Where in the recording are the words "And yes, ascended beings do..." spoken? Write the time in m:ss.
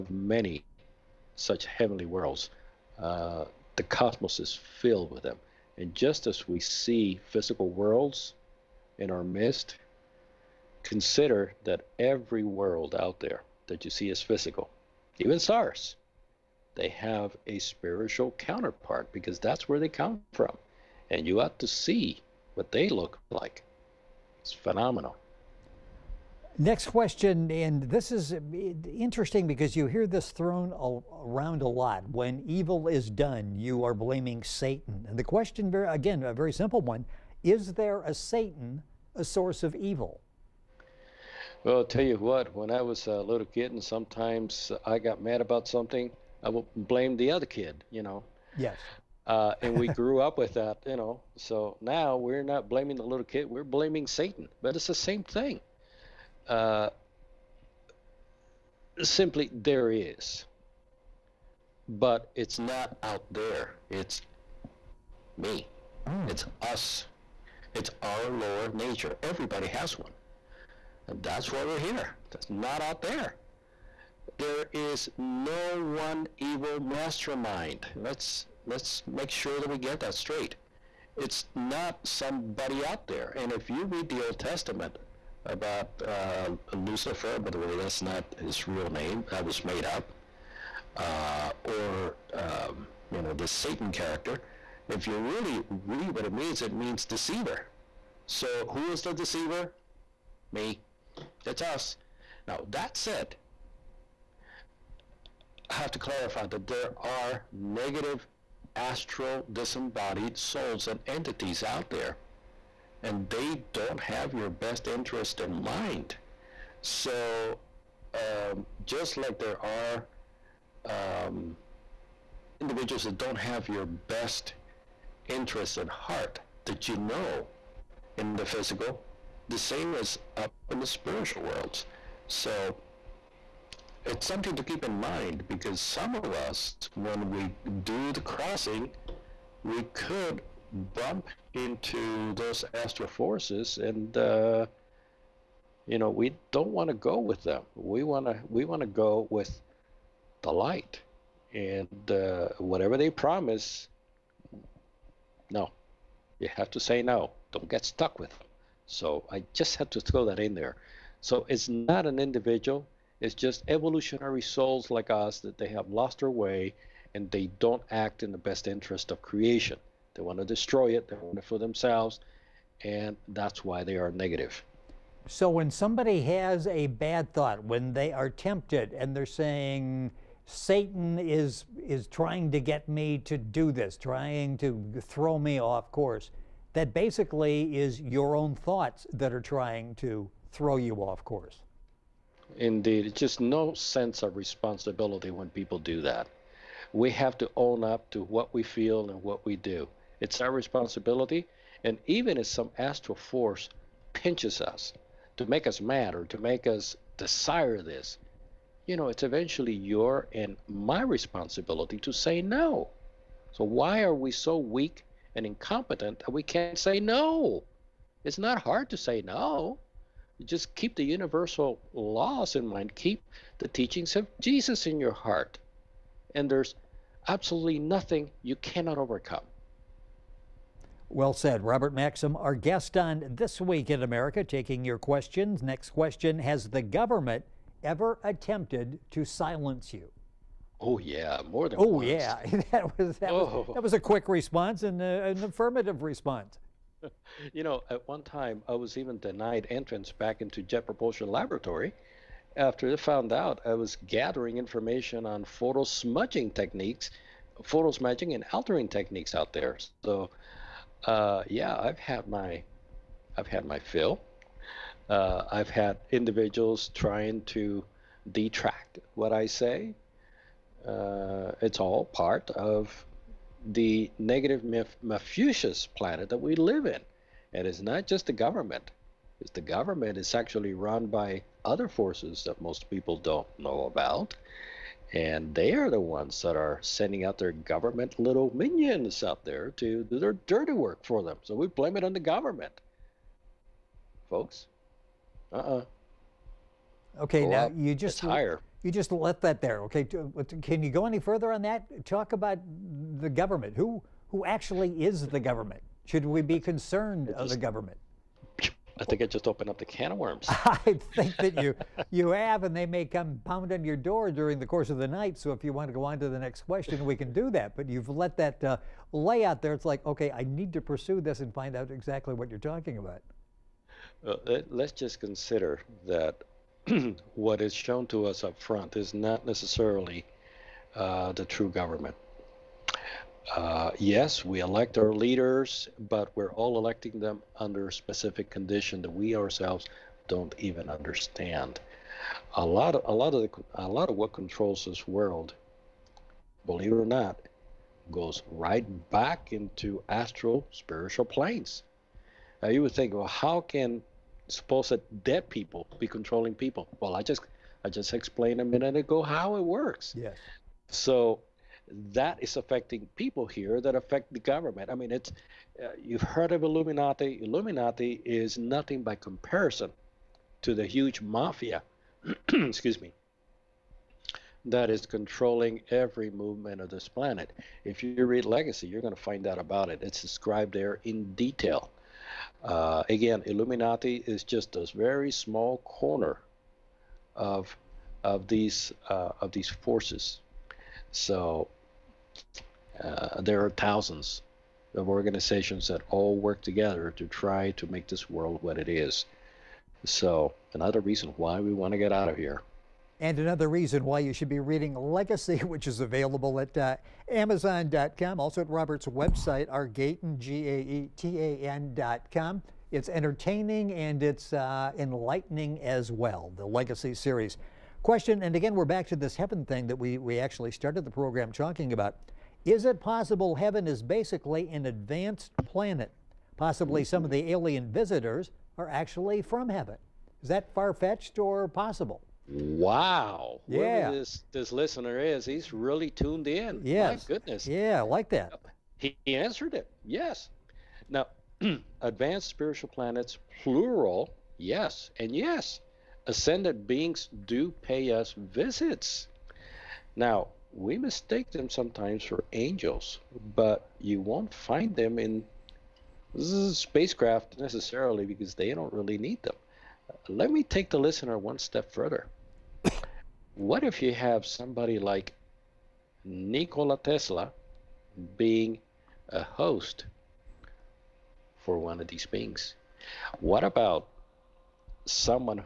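7:25.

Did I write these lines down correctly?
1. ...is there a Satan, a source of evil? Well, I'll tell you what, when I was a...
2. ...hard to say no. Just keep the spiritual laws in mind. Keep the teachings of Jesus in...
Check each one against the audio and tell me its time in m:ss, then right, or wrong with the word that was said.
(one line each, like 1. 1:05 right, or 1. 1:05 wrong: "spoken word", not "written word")
1. 0:37 right
2. 3:38 wrong: "universal", not "spiritual".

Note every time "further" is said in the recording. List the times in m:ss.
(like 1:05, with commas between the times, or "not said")
5:01, 7:41.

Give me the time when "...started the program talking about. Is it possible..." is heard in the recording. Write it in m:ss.
7:00.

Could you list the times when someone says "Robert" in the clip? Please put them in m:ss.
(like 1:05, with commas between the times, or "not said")
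3:51, 6:48.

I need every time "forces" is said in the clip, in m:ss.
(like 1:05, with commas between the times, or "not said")
2:23, 3:23, 4:41, 6:29.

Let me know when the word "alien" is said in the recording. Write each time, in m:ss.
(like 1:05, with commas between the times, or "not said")
7:07.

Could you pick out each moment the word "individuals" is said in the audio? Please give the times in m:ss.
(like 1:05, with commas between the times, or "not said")
2:02, 2:42, 4:26.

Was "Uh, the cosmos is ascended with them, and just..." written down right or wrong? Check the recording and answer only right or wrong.
wrong.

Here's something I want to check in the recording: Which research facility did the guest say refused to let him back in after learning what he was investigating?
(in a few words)
Jet Propulsion Laboratory.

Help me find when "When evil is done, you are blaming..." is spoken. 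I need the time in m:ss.
0:32.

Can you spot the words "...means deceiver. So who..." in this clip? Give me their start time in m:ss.
1:36.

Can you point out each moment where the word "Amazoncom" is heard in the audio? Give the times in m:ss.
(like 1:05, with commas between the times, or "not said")
6:47.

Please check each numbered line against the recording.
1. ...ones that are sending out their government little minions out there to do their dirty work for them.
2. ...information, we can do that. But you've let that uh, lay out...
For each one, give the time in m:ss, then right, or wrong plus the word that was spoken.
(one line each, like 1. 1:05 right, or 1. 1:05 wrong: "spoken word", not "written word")
1. 4:45 right
2. 5:16 wrong: "question", not "information".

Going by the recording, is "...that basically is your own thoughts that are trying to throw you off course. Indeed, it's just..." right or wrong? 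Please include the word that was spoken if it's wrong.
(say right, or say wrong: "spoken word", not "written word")
right.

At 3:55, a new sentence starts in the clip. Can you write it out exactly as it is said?
Next question Has the government ever attempted to silence you?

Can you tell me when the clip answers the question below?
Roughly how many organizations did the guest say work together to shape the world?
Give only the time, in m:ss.
6:33.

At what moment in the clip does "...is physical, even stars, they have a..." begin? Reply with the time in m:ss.
0:14.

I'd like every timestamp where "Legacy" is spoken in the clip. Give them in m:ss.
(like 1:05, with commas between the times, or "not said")
6:18, 6:44, 6:56.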